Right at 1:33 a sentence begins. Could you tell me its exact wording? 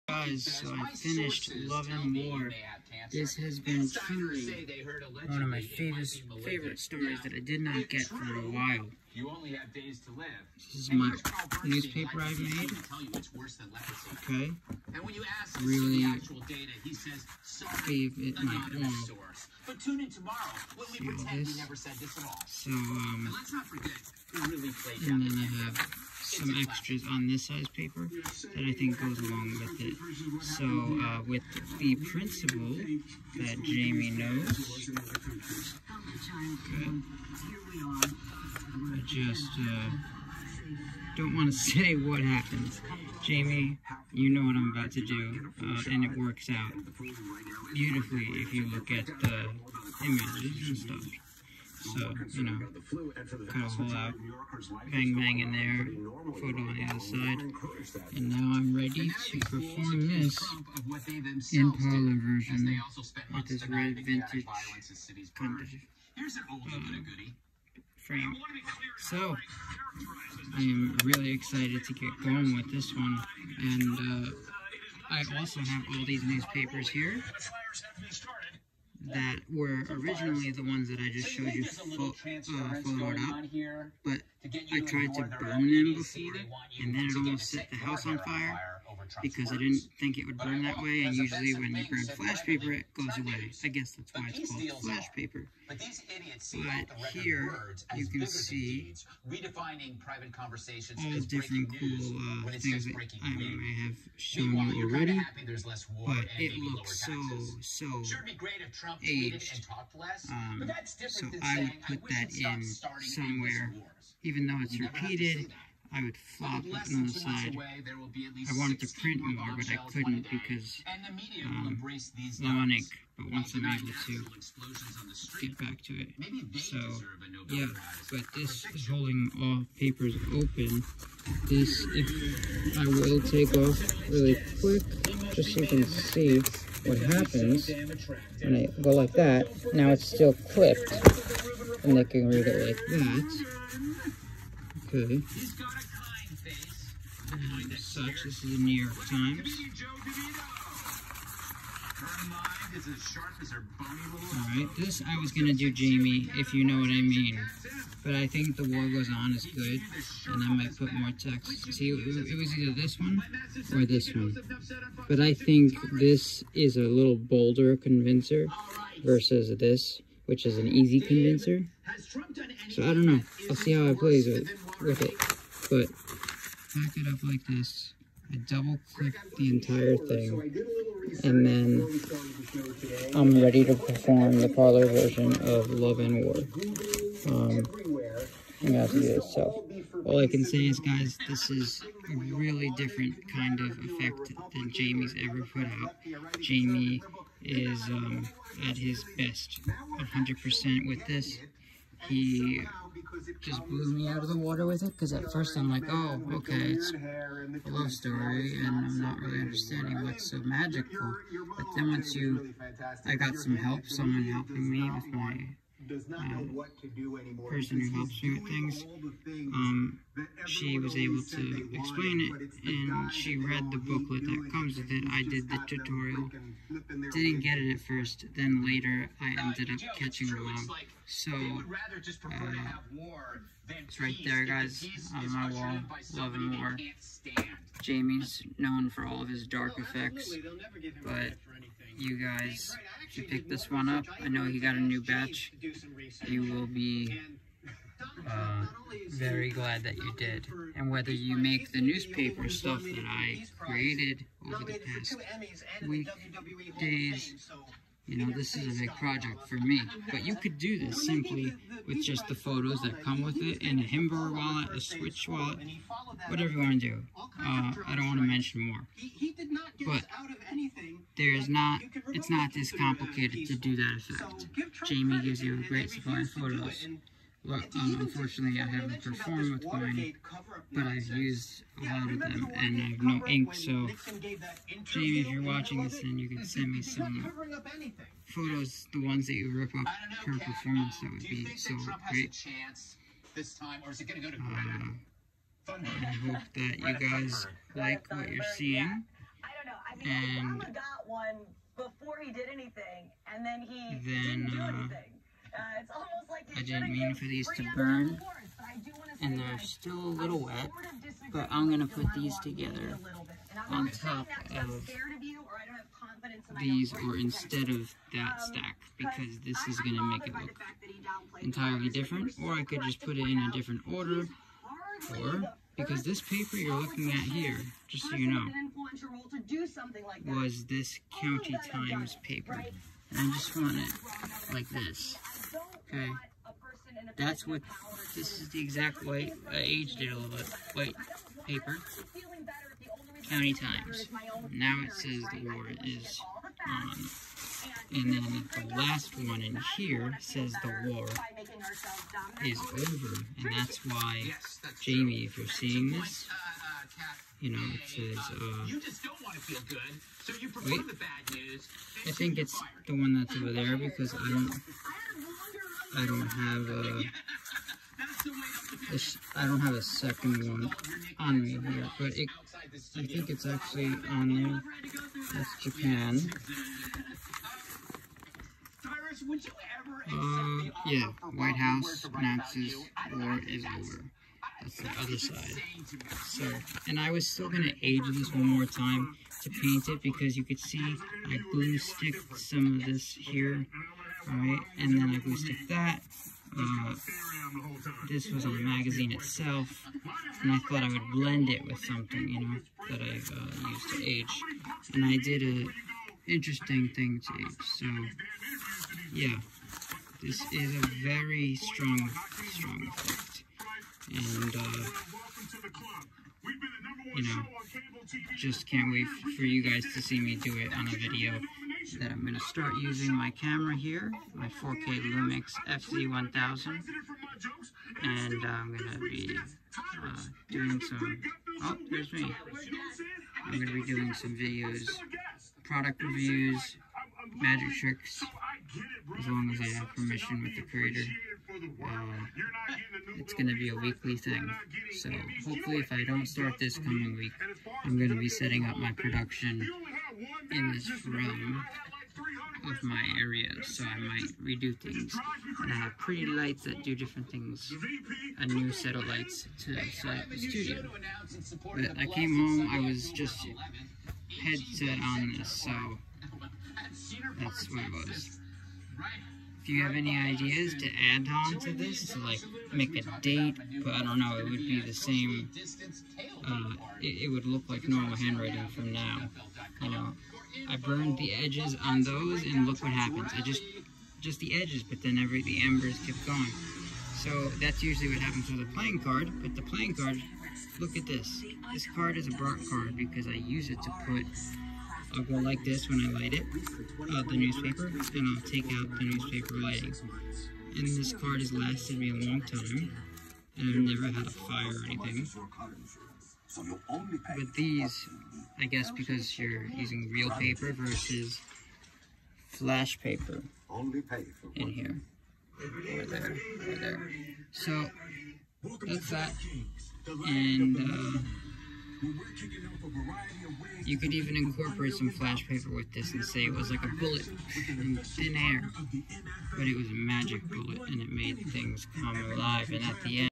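I guess that's why it's called flash paper.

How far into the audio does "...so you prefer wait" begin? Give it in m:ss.
6:00.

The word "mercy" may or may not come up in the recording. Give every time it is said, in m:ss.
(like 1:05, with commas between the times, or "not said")
not said.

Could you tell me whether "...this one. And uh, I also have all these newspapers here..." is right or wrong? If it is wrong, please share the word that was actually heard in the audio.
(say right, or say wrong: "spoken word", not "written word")
right.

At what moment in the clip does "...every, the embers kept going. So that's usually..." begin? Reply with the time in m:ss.
8:05.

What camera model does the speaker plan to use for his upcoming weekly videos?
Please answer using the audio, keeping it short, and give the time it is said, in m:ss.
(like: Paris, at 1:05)
Lumix FZ1000, at 7:05.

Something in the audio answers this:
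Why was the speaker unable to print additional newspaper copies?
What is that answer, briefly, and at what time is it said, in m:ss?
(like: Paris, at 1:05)
low ink, at 2:01.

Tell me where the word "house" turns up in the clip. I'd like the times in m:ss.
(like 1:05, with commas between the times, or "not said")
1:27, 6:21.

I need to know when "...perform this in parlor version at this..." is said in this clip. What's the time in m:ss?
0:59.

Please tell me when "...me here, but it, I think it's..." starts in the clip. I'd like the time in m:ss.
6:11.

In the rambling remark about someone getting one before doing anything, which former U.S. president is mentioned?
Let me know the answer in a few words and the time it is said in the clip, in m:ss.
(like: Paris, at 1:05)
Obama, at 5:00.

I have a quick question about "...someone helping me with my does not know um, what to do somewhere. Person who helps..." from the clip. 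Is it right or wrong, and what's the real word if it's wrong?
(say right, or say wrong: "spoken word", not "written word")
wrong: "anymore", not "somewhere".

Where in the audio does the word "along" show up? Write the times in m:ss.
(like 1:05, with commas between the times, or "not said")
0:29.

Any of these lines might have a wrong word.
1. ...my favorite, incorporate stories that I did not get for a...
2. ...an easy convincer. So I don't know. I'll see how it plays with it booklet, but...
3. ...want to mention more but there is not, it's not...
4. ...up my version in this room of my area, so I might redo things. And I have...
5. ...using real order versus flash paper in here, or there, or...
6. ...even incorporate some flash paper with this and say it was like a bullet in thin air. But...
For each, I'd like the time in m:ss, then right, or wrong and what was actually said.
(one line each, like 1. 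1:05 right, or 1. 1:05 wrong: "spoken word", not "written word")
1. 0:05 wrong: "favorite", not "incorporate"
2. 2:50 wrong: "rivet", not "booklet"
3. 4:28 right
4. 7:28 wrong: "production", not "version"
5. 8:29 wrong: "paper", not "order"
6. 8:44 right.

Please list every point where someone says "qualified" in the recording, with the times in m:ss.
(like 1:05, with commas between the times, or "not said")
not said.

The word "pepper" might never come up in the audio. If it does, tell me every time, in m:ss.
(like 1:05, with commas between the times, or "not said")
not said.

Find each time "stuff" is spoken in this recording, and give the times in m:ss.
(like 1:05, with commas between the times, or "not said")
0:50, 4:12.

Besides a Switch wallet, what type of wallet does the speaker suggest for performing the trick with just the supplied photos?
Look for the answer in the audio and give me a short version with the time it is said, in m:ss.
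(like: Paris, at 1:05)
Himber wallet, at 4:23.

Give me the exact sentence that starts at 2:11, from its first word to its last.
This, if I will take off really quick, just so you can see what happens when I go like that.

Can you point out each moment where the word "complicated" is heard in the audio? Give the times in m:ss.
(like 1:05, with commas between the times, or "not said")
4:32.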